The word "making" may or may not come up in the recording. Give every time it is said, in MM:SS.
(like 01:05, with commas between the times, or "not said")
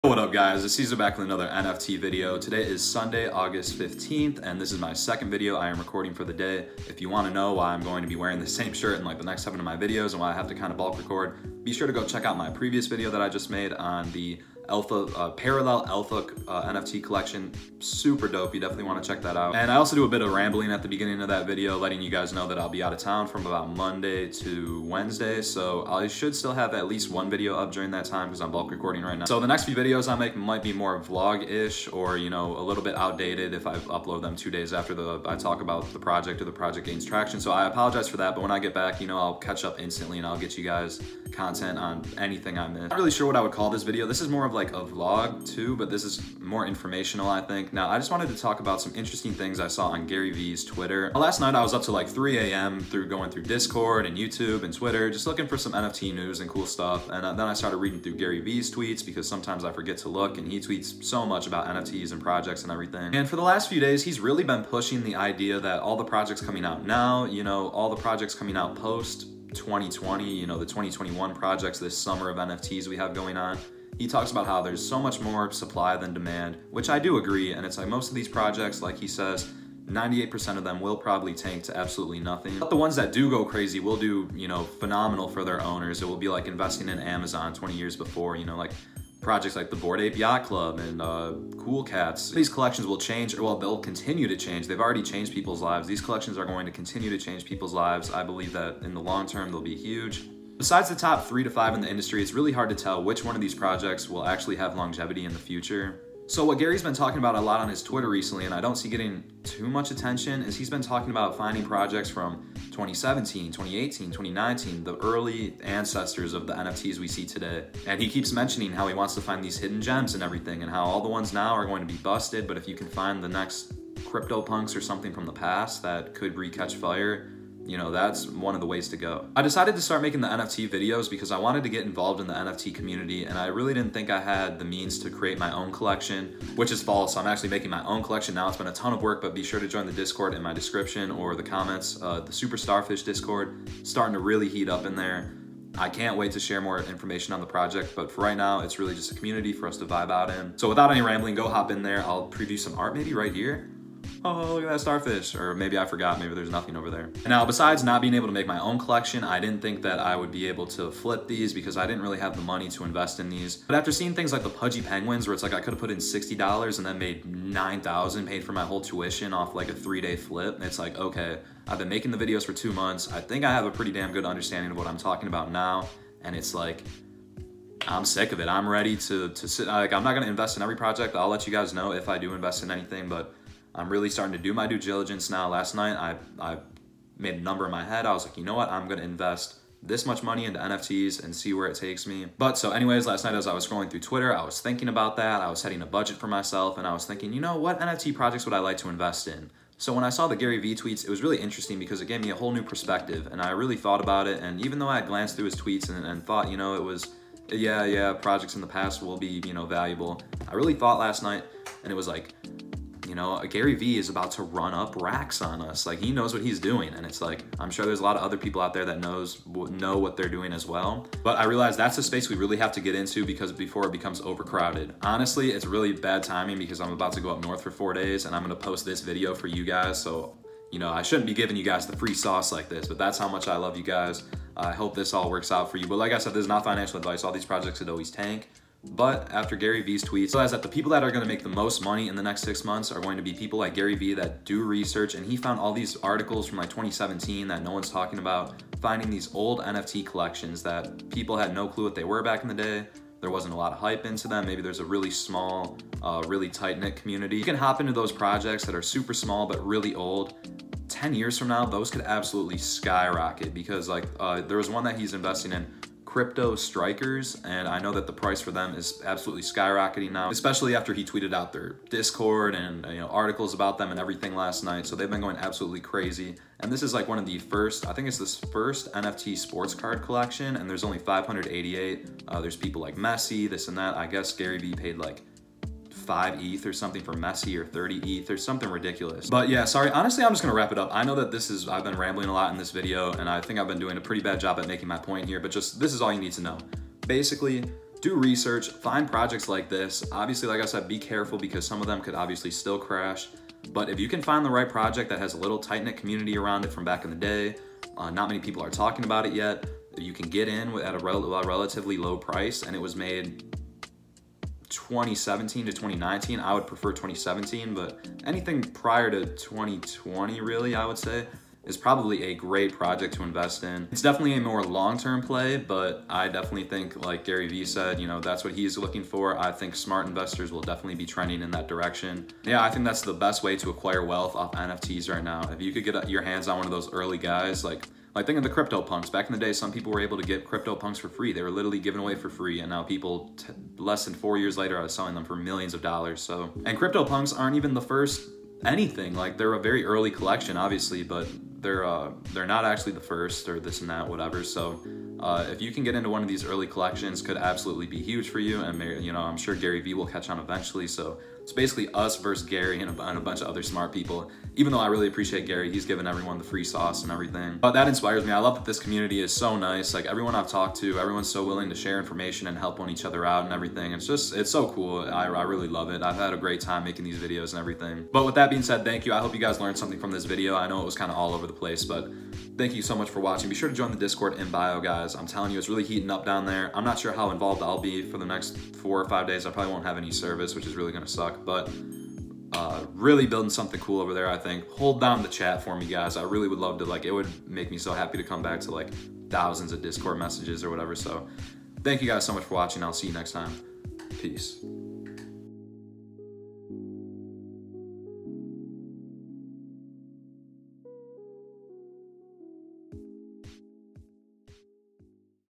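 02:10, 02:17, 02:51, 04:54, 06:16.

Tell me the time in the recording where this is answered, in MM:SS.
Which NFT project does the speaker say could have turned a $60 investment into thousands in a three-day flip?
02:44.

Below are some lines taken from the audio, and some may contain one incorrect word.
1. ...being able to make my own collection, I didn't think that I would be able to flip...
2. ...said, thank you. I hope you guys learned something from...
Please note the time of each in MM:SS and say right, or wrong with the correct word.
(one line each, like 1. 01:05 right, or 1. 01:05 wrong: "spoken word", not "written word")
1. 02:38 right
2. 06:18 right.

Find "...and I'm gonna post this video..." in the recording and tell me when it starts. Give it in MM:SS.
03:48.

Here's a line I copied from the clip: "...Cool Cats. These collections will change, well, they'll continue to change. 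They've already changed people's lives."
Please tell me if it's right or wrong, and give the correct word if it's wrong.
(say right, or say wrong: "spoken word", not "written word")
right.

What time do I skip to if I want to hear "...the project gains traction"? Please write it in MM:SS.
00:36.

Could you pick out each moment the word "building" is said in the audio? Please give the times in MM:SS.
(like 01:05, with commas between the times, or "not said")
06:33.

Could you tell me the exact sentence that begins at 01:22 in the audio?
But the ones that do go crazy will do, you know, phenomenal for their owners.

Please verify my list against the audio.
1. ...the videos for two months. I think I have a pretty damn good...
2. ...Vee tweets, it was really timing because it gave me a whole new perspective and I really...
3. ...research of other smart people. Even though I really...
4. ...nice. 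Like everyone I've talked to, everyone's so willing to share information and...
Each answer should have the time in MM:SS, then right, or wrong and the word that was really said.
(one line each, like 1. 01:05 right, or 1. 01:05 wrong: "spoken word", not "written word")
1. 02:52 right
2. 03:20 wrong: "interesting", not "timing"
3. 06:03 wrong: "bunch", not "research"
4. 06:09 right.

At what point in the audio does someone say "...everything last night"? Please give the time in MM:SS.
04:33.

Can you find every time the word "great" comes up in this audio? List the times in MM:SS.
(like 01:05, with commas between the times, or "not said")
05:22, 06:16.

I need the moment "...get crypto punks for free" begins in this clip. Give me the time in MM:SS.
05:40.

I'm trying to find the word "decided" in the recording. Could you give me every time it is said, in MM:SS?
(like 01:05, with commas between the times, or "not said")
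02:09.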